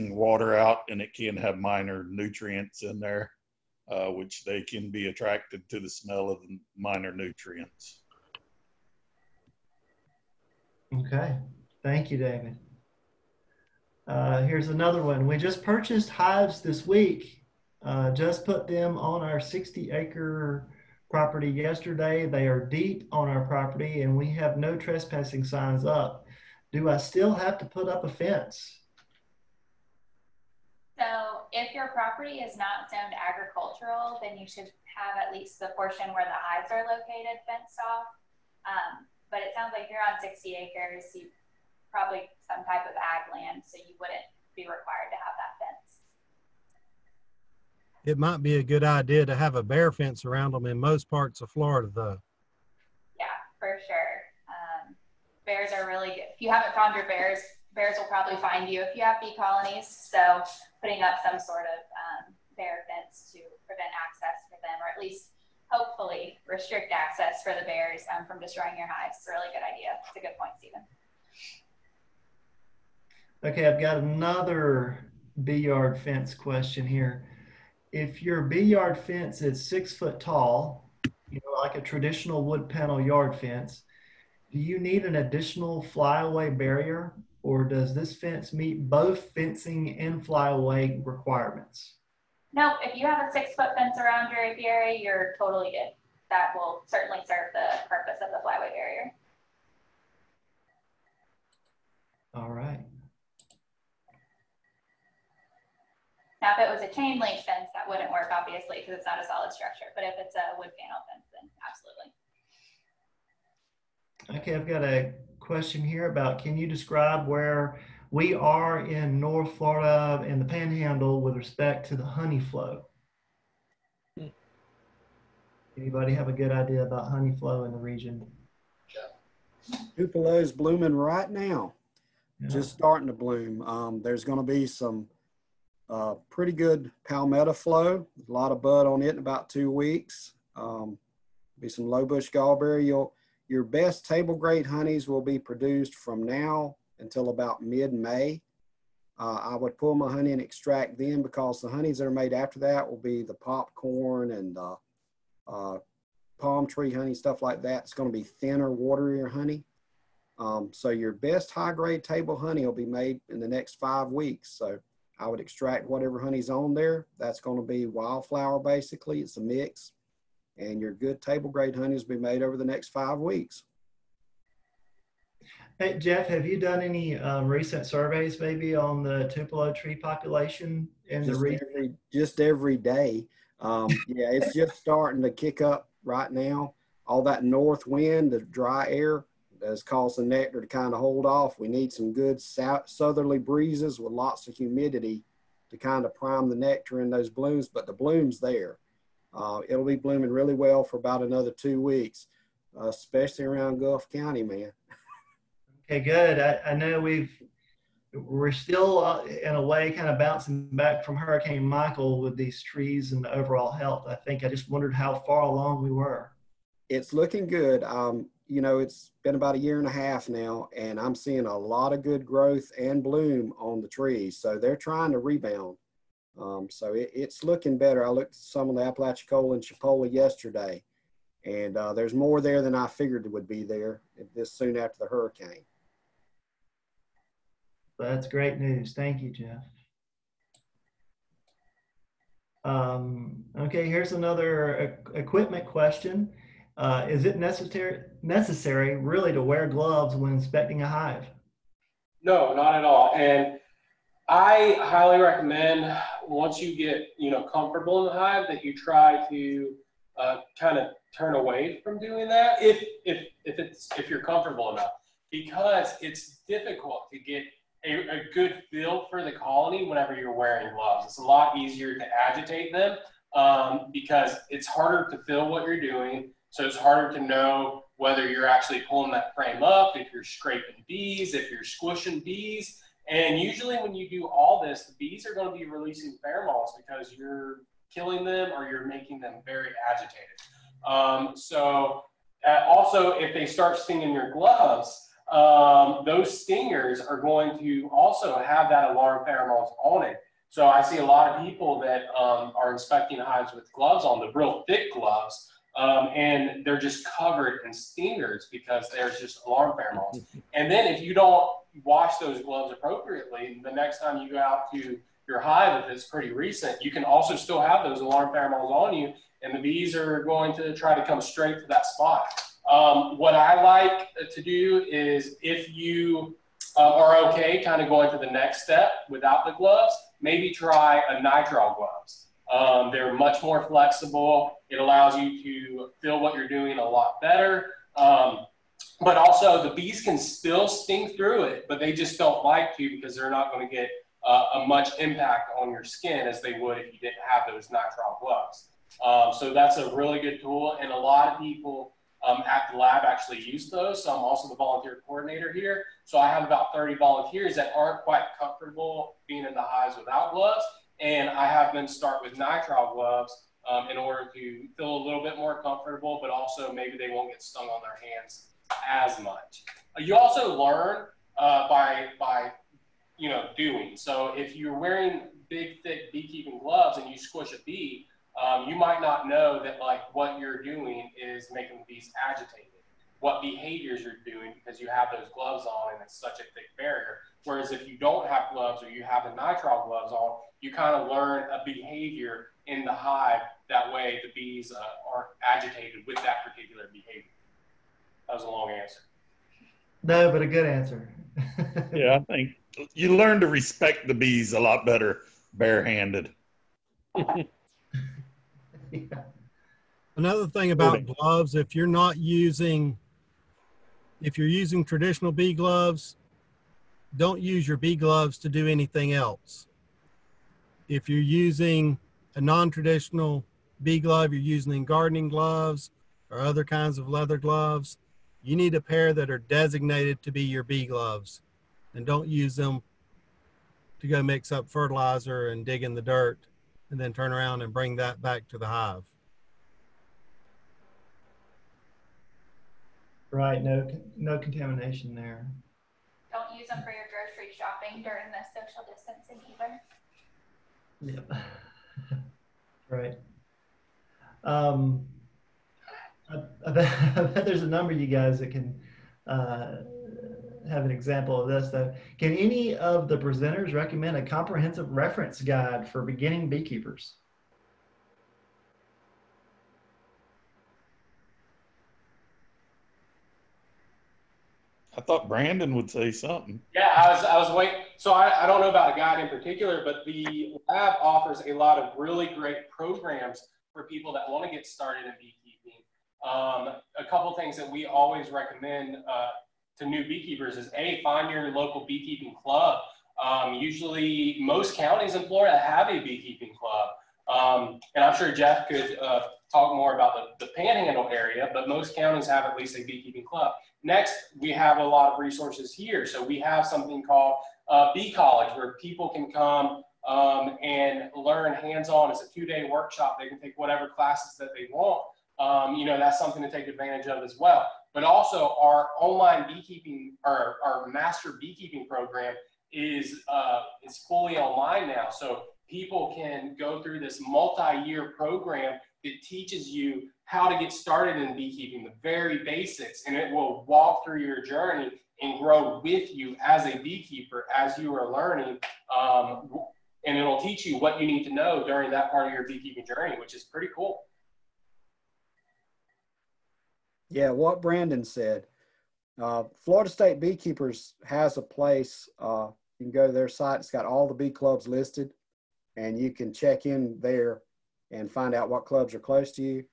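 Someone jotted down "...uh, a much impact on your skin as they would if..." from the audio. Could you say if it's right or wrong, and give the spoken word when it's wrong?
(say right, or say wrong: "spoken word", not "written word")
right.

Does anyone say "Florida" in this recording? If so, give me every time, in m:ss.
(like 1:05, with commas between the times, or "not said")
0:51, 1:59, 8:15, 9:09.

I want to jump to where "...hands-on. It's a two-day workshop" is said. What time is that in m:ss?
8:31.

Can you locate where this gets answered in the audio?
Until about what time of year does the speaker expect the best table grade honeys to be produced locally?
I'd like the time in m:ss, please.
2:27.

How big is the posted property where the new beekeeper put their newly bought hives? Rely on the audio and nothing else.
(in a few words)
60 acres.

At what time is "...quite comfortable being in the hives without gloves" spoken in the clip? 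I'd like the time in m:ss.
5:58.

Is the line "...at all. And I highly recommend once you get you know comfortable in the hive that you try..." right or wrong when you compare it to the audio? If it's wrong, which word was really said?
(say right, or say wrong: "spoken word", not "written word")
right.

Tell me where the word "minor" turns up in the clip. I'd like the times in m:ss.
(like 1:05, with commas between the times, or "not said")
0:01, 0:06.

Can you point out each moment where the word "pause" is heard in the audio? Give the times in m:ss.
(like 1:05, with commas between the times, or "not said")
not said.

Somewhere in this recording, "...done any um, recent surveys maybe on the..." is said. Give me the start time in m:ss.
2:56.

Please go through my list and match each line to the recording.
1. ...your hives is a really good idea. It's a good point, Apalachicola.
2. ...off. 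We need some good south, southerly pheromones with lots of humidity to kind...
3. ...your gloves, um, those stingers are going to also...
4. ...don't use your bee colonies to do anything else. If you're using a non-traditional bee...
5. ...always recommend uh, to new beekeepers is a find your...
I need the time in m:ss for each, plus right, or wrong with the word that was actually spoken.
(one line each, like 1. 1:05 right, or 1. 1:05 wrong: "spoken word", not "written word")
1. 1:08 wrong: "Stephen", not "Apalachicola"
2. 3:11 wrong: "breezes", not "pheromones"
3. 4:54 right
4. 6:57 wrong: "gloves", not "colonies"
5. 8:07 right.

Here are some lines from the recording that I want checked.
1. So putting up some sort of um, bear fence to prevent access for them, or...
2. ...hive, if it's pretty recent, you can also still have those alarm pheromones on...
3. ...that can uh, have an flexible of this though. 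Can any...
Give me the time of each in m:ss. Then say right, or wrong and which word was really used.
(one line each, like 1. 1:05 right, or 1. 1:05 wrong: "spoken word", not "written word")
1. 0:59 right
2. 5:15 right
3. 7:38 wrong: "example", not "flexible".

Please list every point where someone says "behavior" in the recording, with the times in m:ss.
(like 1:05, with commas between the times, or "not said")
6:23, 6:31, 6:36.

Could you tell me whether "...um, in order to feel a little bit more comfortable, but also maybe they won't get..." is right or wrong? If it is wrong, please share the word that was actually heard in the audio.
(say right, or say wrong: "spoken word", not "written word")
right.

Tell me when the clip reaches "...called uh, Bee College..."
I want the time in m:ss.
8:27.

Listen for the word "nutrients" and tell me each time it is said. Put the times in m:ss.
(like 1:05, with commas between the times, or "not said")
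0:02, 0:07.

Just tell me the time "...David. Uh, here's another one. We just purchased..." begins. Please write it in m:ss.
0:12.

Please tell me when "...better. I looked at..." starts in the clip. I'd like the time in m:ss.
3:47.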